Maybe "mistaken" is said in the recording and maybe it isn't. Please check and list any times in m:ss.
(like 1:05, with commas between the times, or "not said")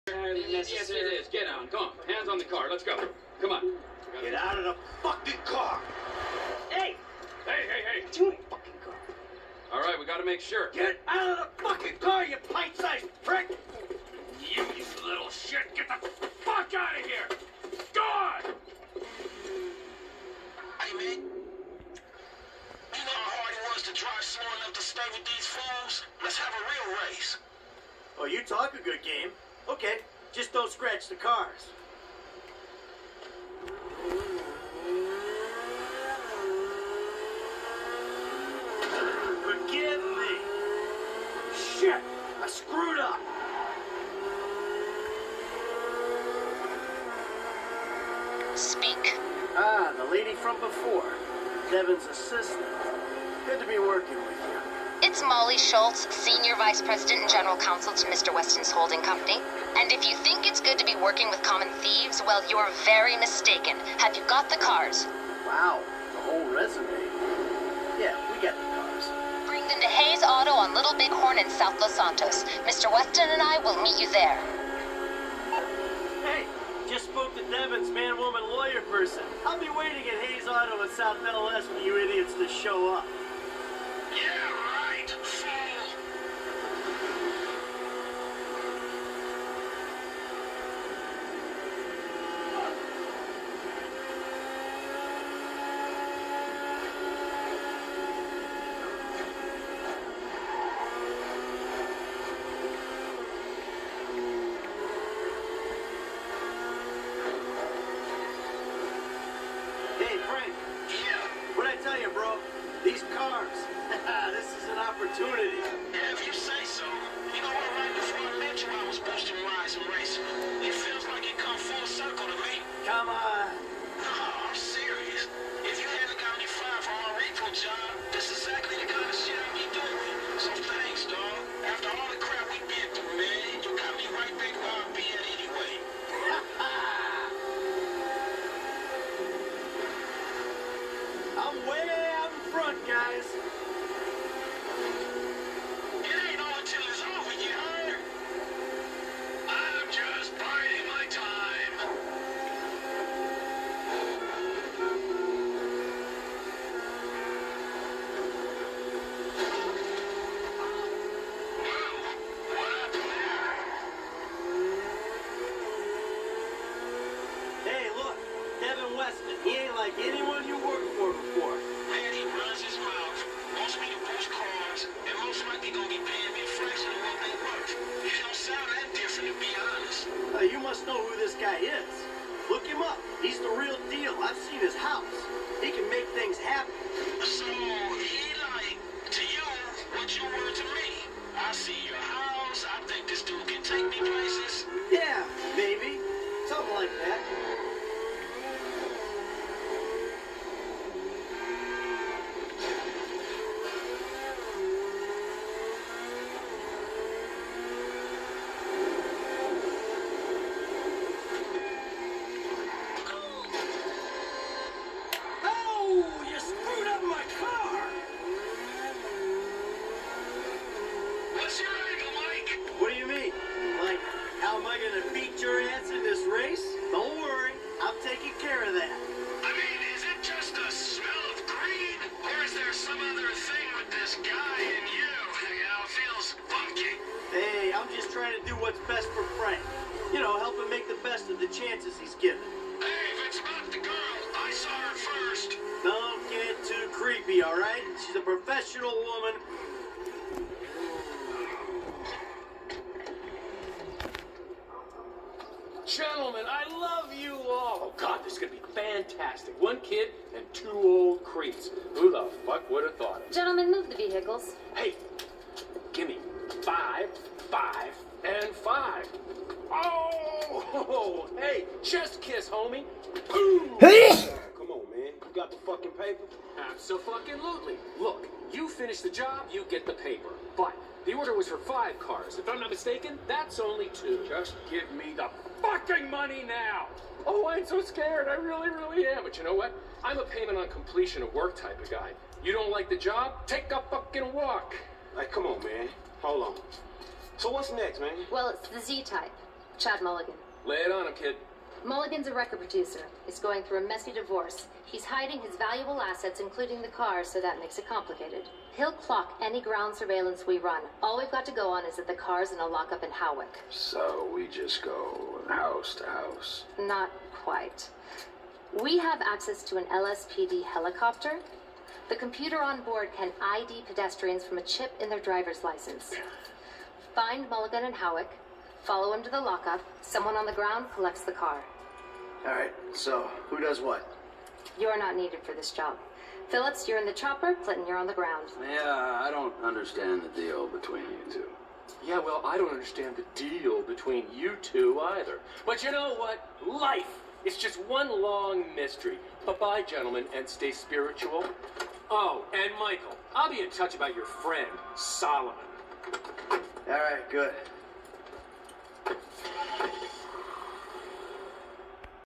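1:03, 4:42.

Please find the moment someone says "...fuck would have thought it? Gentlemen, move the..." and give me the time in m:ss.
4:22.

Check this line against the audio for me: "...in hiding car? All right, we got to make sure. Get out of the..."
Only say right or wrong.
wrong.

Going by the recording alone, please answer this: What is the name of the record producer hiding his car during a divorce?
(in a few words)
Chad Mulligan.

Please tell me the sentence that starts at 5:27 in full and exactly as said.
Find Mulligan and Hawick, follow him to the lockup.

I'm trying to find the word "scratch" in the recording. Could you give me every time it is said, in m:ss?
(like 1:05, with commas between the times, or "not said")
0:30.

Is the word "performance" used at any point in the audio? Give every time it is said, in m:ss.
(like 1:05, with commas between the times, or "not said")
not said.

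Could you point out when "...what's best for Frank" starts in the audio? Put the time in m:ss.
3:58.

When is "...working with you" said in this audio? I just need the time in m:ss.
0:53.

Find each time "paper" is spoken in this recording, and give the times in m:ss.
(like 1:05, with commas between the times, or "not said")
4:35, 4:39.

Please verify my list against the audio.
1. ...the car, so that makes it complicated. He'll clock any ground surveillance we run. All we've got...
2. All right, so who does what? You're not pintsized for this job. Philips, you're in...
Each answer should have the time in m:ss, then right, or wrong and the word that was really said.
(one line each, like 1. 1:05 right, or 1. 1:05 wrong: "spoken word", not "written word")
1. 5:06 right
2. 5:32 wrong: "needed", not "pintsized".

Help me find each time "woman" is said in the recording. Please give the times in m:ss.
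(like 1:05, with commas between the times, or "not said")
1:17, 4:08.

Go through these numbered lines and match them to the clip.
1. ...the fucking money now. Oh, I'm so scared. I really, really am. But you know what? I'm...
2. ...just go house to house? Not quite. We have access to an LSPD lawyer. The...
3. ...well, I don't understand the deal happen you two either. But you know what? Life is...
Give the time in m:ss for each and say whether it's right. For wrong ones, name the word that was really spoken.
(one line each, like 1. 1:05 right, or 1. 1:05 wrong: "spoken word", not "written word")
1. 4:45 right
2. 5:14 wrong: "helicopter", not "lawyer"
3. 5:42 wrong: "between", not "happen".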